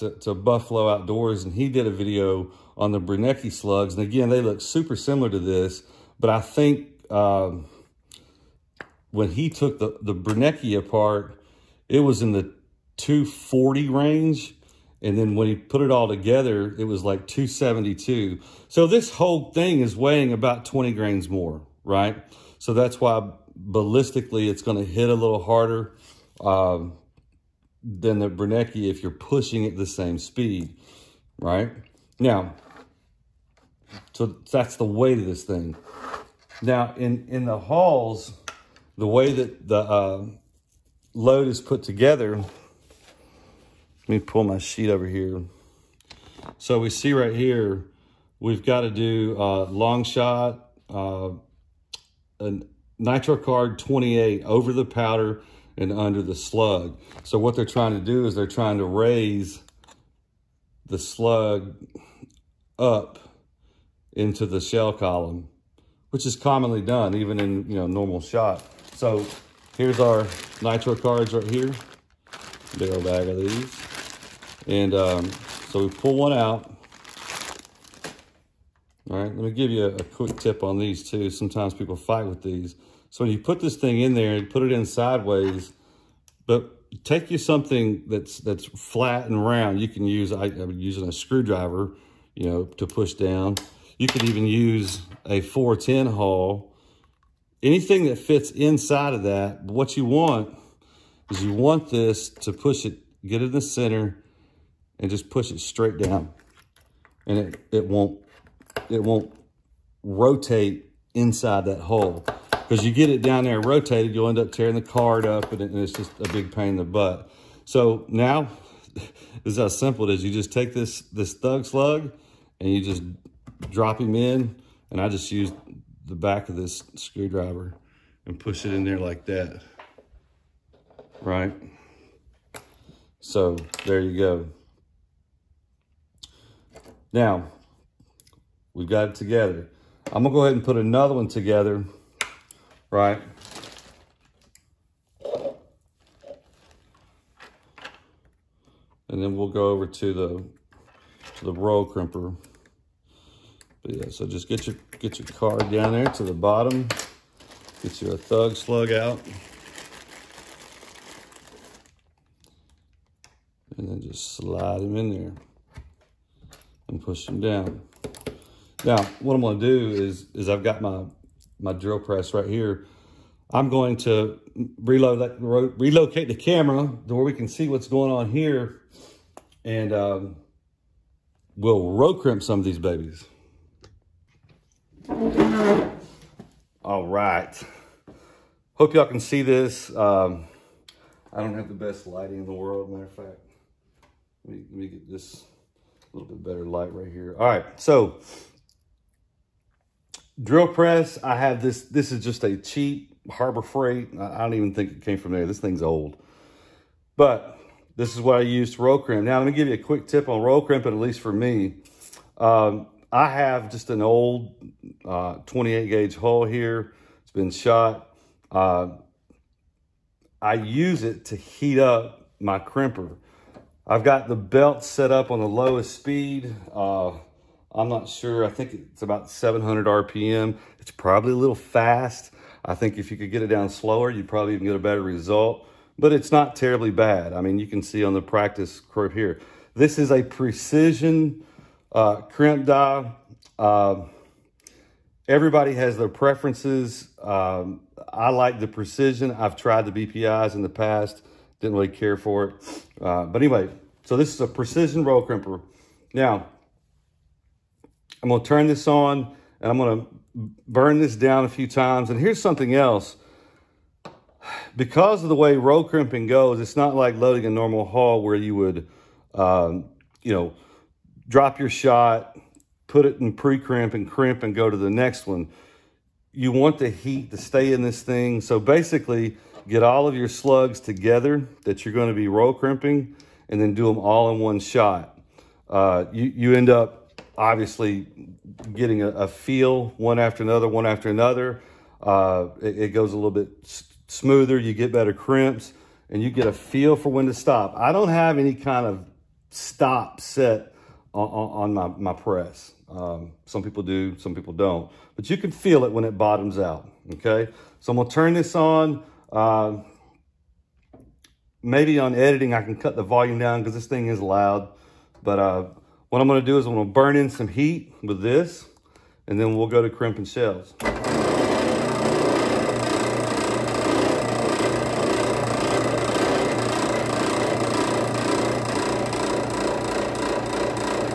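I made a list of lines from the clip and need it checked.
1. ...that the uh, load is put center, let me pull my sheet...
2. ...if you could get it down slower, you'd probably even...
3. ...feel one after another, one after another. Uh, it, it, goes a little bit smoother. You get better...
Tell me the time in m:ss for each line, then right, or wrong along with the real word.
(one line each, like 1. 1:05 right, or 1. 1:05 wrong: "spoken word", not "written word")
1. 0:39 wrong: "together", not "center"
2. 3:52 right
3. 4:49 right.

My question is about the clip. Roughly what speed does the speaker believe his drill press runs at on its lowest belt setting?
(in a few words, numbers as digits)
700 RPM.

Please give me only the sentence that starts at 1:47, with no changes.
And it, it won't, it won't rotate inside that hole.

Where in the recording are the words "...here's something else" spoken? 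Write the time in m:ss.
4:22.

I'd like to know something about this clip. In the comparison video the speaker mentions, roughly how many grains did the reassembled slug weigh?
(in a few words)
272.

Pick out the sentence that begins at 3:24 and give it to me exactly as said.
I don't even think it came from there.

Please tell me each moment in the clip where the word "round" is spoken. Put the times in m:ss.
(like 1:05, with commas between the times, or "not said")
1:29.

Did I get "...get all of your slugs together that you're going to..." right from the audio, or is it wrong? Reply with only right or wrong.
right.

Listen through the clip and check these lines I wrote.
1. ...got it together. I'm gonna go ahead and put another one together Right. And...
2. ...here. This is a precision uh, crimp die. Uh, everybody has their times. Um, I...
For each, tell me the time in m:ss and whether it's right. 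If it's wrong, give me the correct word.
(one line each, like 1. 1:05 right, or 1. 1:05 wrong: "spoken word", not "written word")
1. 2:18 right
2. 3:59 wrong: "preferences", not "times".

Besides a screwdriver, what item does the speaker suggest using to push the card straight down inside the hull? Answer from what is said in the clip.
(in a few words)
410 hull.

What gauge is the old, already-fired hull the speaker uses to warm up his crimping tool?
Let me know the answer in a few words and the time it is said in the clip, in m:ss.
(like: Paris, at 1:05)
28 gauge, at 3:35.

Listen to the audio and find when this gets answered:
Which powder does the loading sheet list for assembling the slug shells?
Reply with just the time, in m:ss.
0:49.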